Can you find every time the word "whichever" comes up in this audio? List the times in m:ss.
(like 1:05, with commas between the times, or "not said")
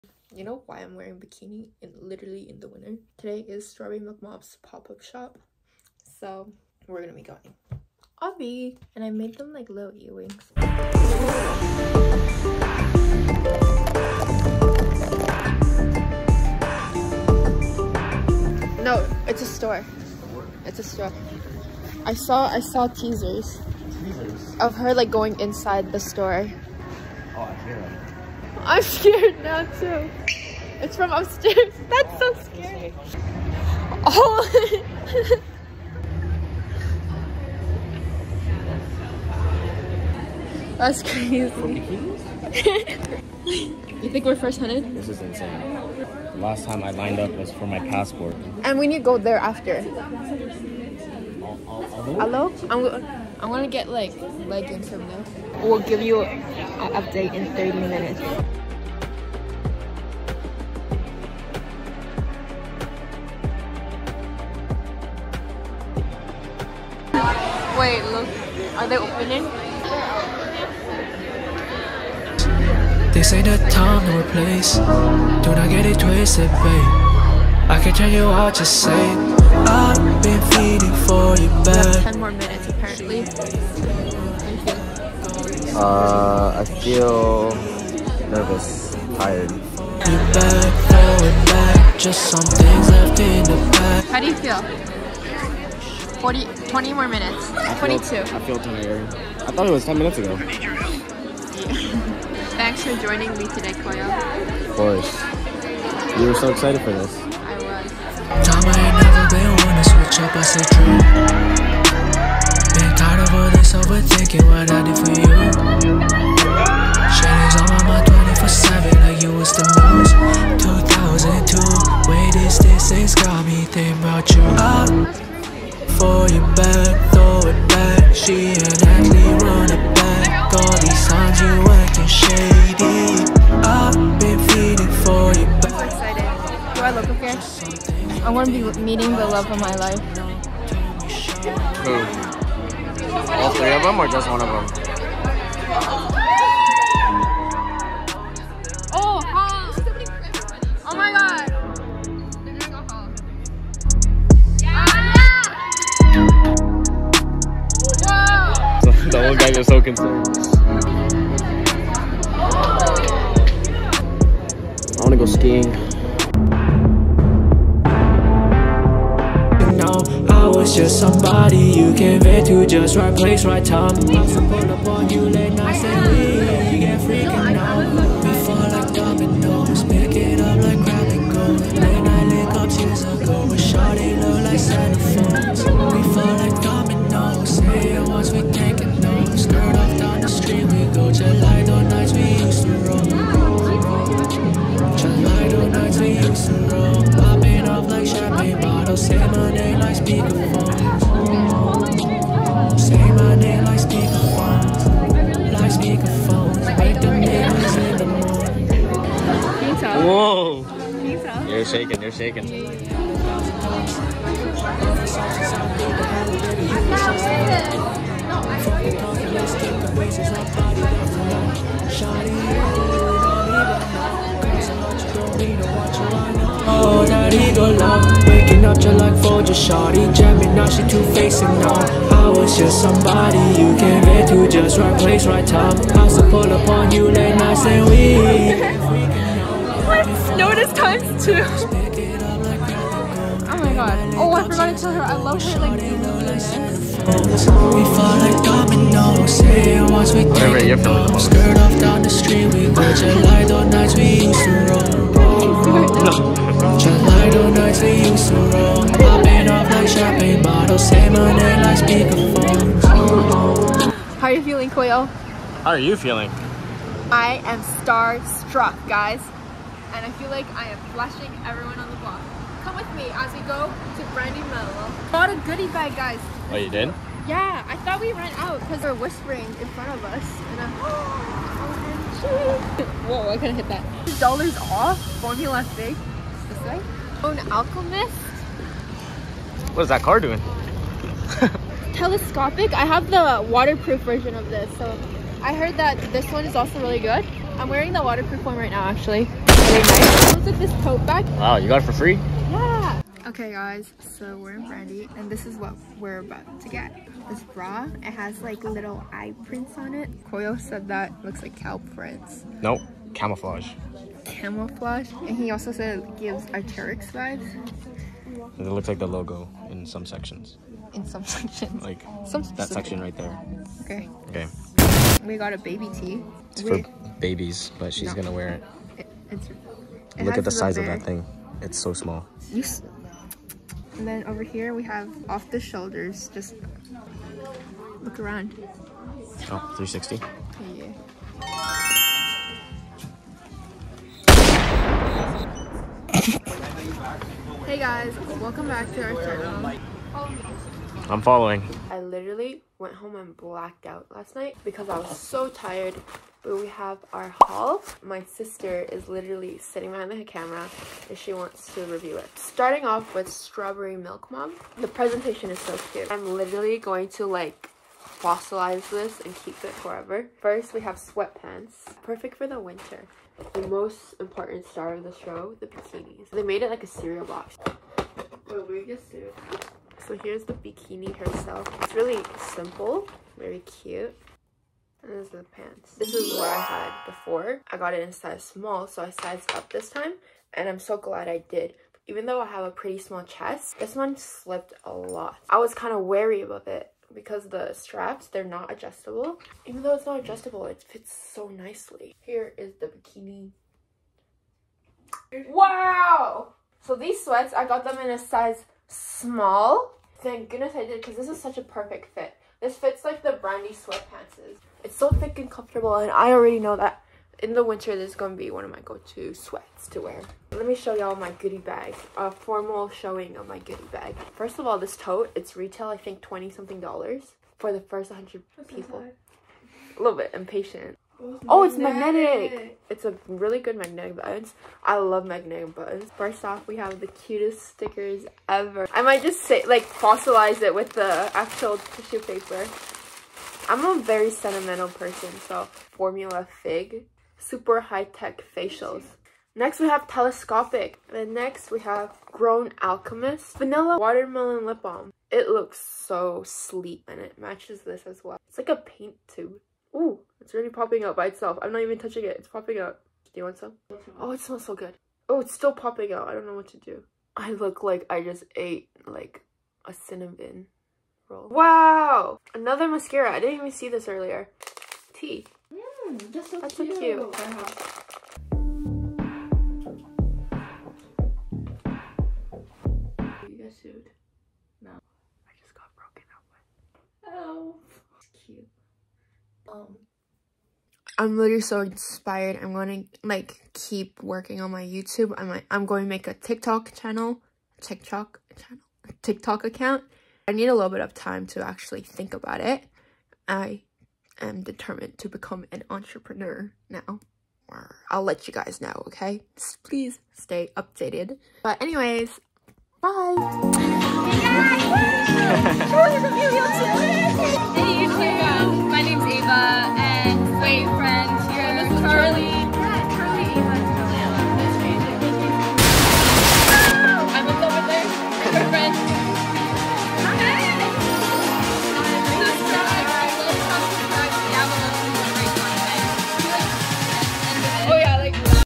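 not said.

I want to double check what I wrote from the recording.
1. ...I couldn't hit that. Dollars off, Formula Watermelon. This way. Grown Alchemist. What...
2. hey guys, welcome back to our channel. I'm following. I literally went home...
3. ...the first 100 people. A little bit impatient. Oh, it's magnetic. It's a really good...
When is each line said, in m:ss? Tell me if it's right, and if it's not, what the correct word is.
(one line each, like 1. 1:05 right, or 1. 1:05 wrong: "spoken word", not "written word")
1. 4:43 wrong: "Fig", not "Watermelon"
2. 5:47 right
3. 7:07 right.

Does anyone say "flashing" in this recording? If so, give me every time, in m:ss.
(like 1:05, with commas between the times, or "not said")
4:30.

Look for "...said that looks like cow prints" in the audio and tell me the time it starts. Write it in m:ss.
5:10.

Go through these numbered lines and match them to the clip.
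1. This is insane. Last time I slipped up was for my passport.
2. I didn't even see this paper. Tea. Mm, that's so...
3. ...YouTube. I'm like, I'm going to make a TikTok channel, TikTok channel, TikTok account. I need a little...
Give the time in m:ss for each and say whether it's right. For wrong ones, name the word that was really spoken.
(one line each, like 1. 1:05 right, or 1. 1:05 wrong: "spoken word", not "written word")
1. 0:44 wrong: "lined", not "slipped"
2. 7:53 wrong: "earlier", not "paper"
3. 8:14 right.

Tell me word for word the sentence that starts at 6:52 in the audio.
This fits like the brandy sweatpants is.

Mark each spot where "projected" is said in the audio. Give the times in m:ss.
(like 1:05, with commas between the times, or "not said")
not said.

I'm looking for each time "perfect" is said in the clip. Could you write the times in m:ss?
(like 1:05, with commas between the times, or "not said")
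6:12, 6:51.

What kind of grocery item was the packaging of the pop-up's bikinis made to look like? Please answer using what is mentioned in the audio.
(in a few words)
Cereal box.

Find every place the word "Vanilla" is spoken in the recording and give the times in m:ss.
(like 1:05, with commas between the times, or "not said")
7:33.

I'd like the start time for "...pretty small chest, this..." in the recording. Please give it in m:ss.
6:32.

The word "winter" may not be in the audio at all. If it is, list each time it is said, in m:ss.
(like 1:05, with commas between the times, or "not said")
0:02, 6:12, 6:57.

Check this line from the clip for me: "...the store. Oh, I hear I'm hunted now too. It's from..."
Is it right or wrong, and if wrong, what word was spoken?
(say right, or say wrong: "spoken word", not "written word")
wrong: "scared", not "hunted".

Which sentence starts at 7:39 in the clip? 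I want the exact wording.
Ooh, it's already popping out by itself.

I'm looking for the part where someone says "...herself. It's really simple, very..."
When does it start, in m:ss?
6:21.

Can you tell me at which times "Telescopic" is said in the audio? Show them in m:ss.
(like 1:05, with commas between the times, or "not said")
4:51, 7:30.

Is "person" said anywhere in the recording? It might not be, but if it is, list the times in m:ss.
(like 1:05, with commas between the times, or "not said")
7:24.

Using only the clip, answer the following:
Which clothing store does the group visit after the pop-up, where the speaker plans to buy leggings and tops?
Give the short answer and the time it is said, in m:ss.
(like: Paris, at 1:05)
Brandy Melville, at 4:34.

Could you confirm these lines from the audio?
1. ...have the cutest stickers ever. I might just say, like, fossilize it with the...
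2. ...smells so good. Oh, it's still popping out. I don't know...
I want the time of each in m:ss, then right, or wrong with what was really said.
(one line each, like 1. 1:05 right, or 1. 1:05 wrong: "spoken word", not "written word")
1. 7:16 right
2. 7:44 right.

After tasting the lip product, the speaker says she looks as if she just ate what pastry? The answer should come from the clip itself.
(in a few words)
Cinnamon roll.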